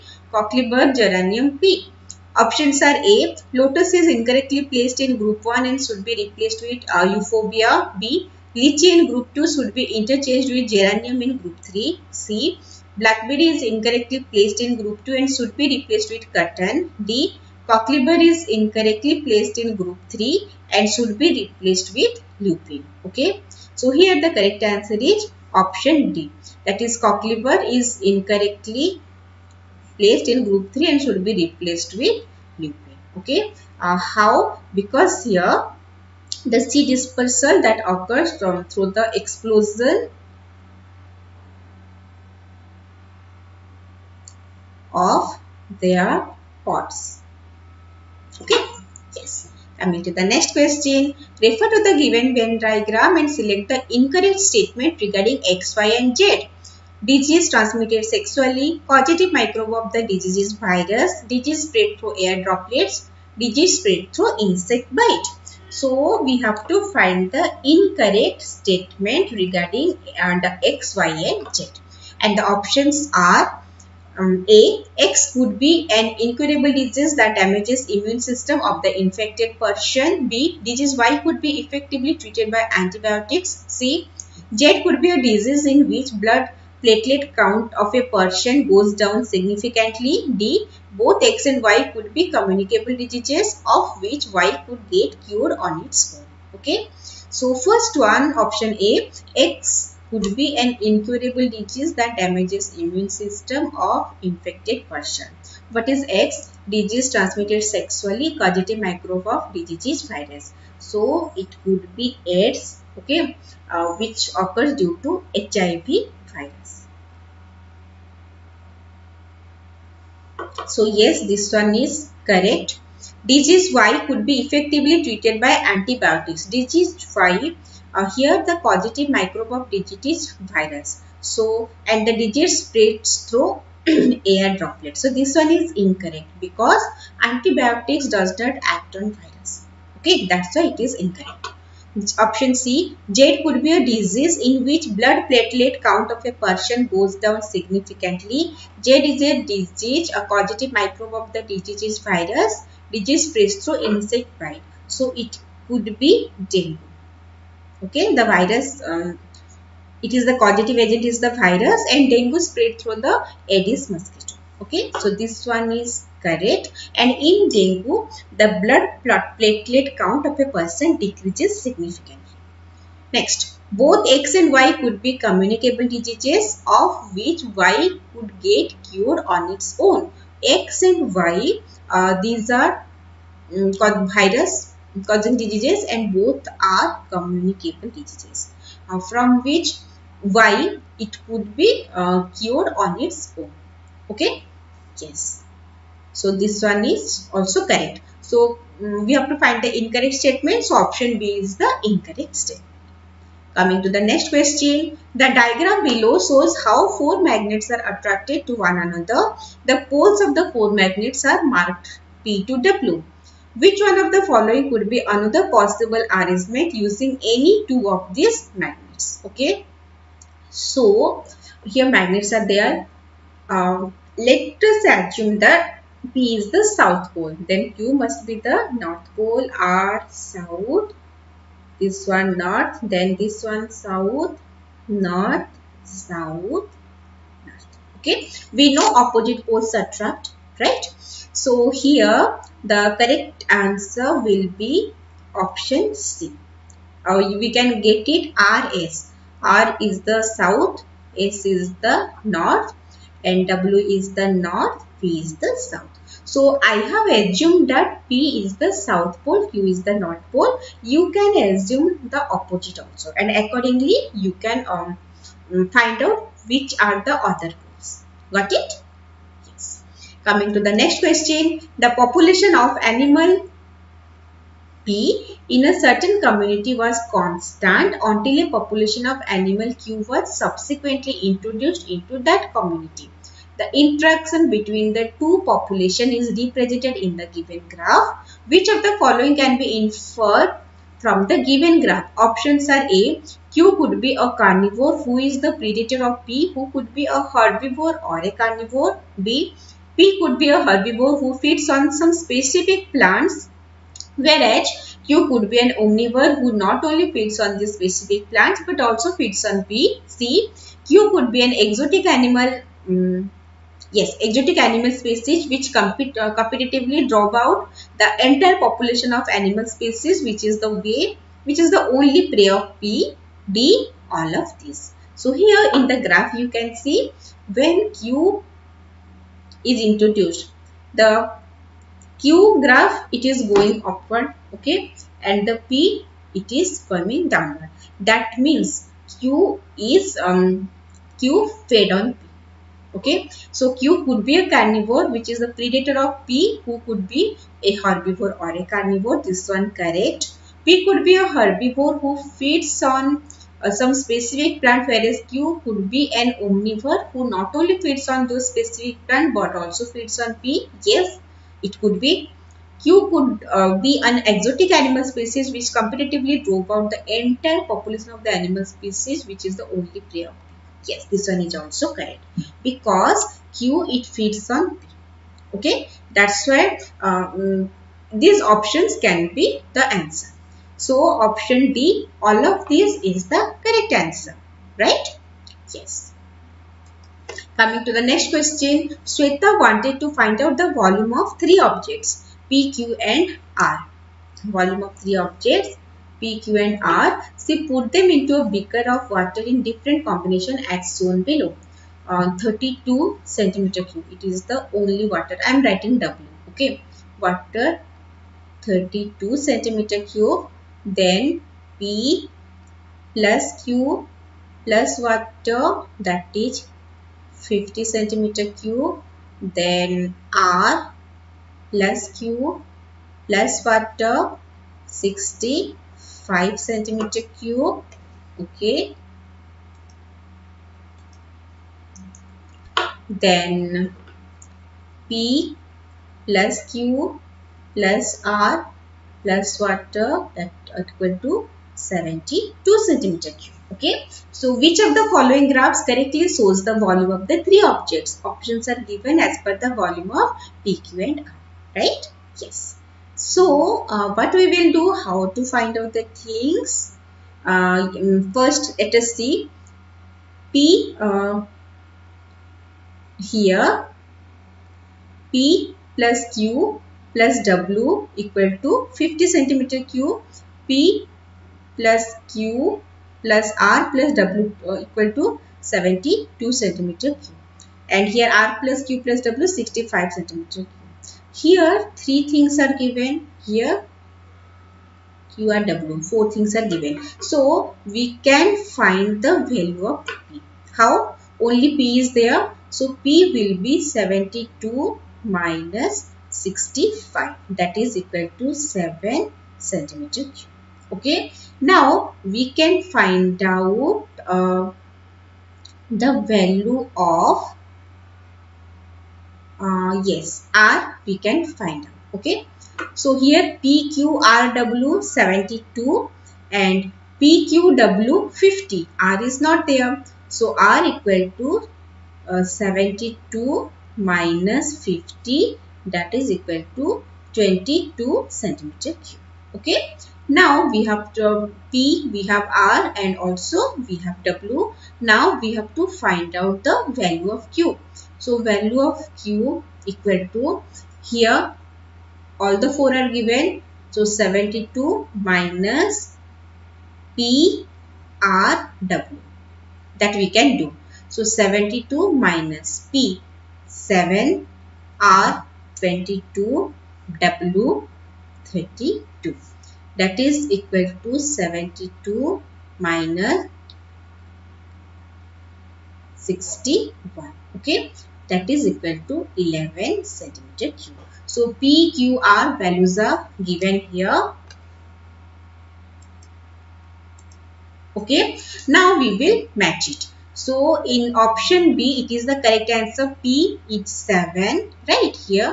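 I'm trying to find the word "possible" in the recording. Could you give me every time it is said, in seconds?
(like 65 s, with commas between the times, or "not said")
215 s.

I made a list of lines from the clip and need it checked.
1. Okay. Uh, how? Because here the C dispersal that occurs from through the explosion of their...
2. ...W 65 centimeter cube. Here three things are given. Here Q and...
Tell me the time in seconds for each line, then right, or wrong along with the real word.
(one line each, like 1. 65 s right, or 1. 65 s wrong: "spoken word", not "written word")
1. 33 s right
2. 479 s right.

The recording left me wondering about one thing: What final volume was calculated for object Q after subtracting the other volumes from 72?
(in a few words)
11 cubic centimeters.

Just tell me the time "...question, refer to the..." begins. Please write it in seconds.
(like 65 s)
50 s.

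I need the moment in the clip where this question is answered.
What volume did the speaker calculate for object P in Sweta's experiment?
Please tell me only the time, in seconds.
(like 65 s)
498 s.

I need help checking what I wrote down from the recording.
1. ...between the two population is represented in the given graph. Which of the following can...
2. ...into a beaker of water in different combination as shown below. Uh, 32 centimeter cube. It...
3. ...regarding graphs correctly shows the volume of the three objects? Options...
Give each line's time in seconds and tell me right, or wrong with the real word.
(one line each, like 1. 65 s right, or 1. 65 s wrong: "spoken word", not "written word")
1. 284 s right
2. 398 s right
3. 445 s wrong: "following", not "regarding".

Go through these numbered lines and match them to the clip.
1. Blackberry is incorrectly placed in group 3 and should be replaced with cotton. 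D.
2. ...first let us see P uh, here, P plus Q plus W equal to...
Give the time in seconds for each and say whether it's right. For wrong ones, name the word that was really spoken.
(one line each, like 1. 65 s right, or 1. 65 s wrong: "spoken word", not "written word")
1. 12 s wrong: "2", not "3"
2. 458 s right.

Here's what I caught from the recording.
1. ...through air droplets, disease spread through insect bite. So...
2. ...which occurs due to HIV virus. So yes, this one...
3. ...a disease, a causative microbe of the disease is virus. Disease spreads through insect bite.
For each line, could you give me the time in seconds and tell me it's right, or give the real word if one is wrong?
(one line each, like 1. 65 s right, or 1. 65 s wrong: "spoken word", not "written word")
1. 61 s right
2. 113 s right
3. 149 s right.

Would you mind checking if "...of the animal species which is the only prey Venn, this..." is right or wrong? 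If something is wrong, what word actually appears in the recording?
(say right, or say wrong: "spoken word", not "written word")
wrong: "Yes", not "Venn".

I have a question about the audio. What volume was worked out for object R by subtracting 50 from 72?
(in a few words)
22 cubic centimeters.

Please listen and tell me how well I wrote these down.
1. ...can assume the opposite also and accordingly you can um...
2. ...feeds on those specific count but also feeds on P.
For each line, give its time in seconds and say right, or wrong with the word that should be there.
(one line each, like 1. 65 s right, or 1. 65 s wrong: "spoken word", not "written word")
1. 261 s right
2. 357 s wrong: "plant", not "count".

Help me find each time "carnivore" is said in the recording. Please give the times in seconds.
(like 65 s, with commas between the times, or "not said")
294 s, 298 s, 344 s, 348 s.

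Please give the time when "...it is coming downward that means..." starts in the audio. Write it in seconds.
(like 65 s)
336 s.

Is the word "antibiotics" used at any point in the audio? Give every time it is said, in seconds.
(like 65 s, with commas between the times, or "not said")
82 s, 125 s, 137 s.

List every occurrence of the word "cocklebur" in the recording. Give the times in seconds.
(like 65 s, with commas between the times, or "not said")
0 s, 17 s, 26 s.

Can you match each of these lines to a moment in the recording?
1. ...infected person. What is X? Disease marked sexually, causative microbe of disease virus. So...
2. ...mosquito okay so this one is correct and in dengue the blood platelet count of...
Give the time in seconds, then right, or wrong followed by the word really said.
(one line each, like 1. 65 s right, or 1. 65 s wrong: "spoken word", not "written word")
1. 104 s wrong: "transmitted", not "marked"
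2. 163 s right.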